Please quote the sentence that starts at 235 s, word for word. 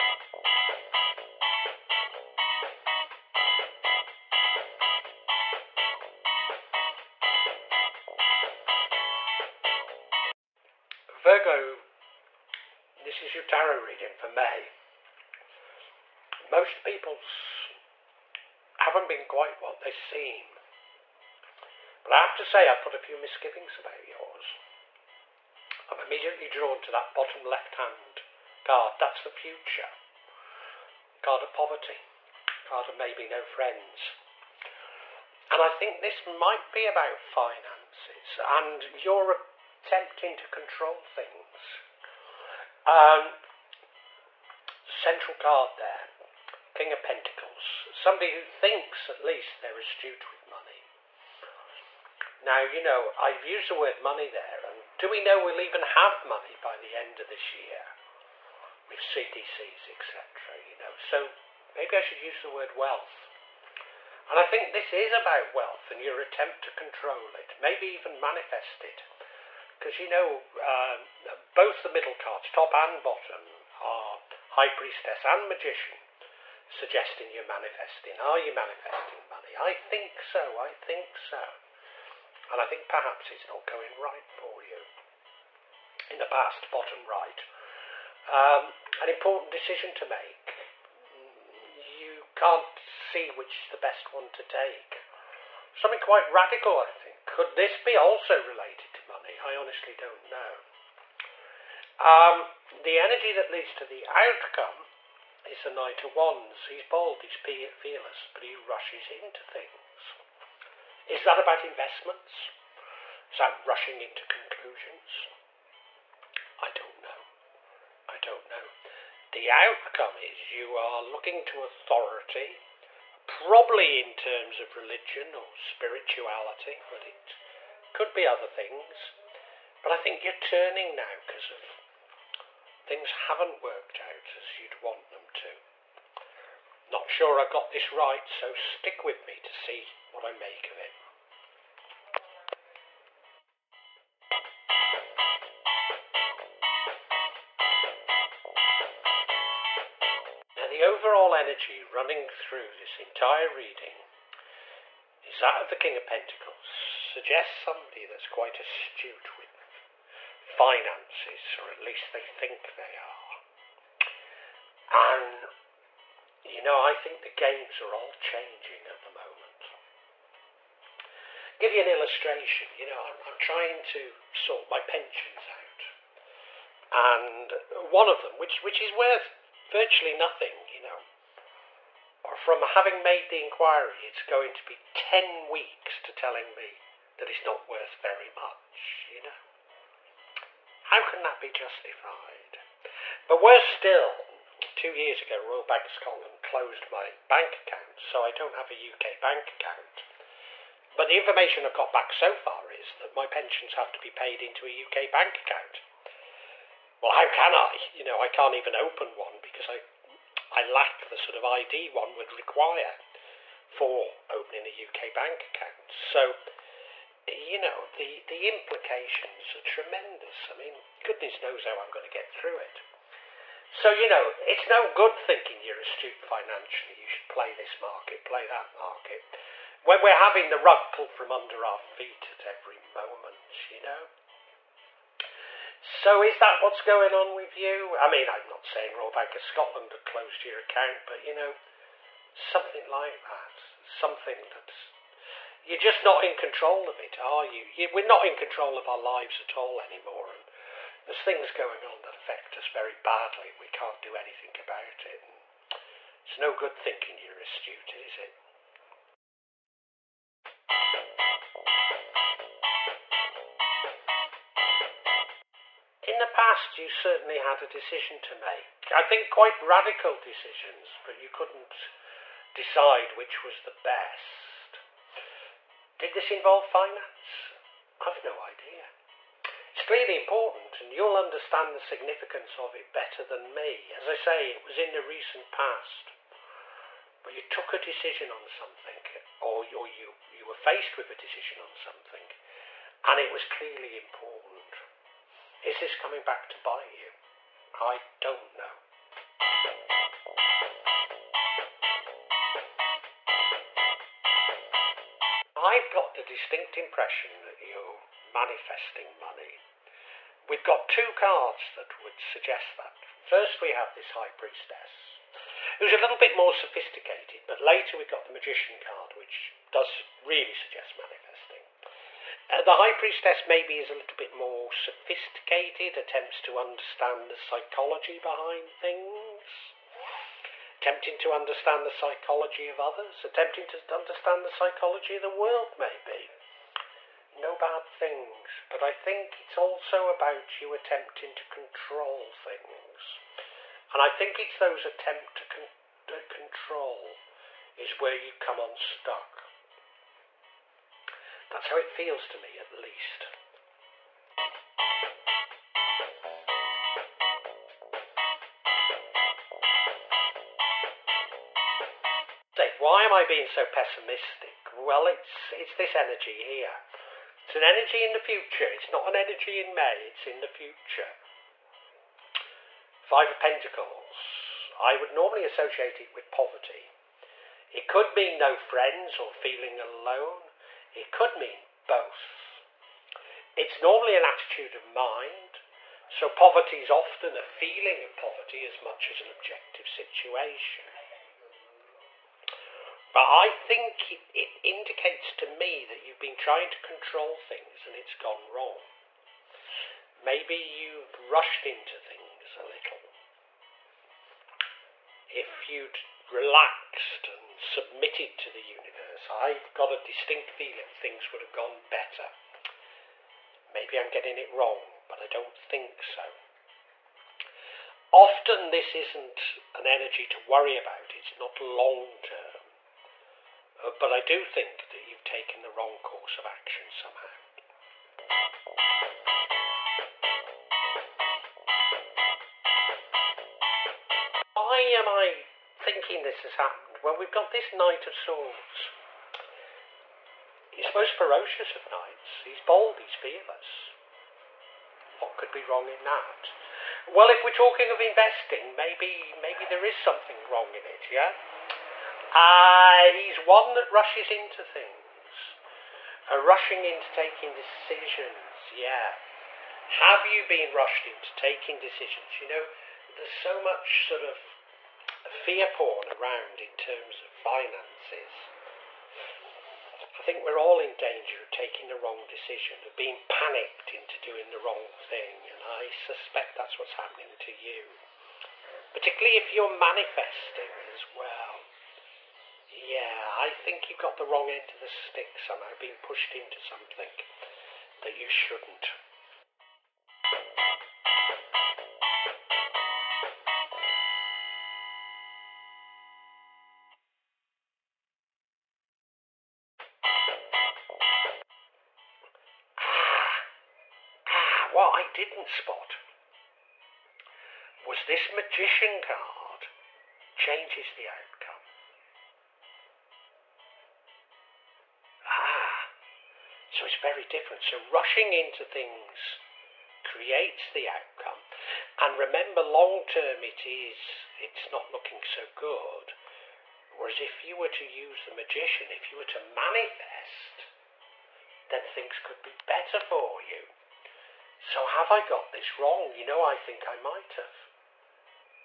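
So is that what's going on with you?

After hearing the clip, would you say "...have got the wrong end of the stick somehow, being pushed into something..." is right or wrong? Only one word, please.
right.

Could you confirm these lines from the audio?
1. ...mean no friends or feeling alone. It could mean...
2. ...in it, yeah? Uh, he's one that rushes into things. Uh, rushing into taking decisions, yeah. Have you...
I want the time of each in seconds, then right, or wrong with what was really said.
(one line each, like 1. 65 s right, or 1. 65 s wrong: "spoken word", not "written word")
1. 378 s right
2. 450 s right.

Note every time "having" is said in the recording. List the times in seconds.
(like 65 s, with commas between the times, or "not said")
182 s, 230 s.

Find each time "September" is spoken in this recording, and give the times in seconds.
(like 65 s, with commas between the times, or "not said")
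not said.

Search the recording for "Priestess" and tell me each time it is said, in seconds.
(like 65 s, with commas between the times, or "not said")
74 s, 314 s, 322 s.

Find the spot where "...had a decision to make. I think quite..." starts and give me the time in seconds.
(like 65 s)
267 s.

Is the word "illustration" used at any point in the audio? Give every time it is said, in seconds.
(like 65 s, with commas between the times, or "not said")
171 s.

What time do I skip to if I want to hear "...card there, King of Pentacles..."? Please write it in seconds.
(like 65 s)
45 s.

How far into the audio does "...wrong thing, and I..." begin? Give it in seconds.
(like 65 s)
474 s.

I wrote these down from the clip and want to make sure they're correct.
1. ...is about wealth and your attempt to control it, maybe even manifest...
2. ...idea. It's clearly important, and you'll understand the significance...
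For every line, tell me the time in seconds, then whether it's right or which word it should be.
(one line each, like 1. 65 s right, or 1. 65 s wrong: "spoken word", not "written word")
1. 64 s right
2. 278 s right.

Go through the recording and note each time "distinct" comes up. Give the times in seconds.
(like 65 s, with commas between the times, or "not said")
306 s, 409 s.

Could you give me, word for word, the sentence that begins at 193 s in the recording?
But worse still, two years ago, Royal Bank of Scotland closed my bank account, so I don't have a UK bank account.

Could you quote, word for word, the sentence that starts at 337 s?
No bad things, but I think it's also about you attempting to control things.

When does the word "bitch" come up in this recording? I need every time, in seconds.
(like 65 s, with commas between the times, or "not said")
not said.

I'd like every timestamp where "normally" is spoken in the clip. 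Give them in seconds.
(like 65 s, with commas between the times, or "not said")
375 s, 383 s.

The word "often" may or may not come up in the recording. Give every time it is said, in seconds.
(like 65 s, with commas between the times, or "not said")
386 s, 418 s.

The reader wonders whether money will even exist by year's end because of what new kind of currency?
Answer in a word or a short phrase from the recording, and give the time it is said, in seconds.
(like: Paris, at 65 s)
CBDCs, at 59 s.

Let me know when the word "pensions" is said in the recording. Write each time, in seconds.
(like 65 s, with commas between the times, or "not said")
174 s, 203 s.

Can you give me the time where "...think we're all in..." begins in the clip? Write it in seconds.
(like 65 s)
470 s.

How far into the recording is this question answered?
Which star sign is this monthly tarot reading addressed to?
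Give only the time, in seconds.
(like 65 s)
11 s.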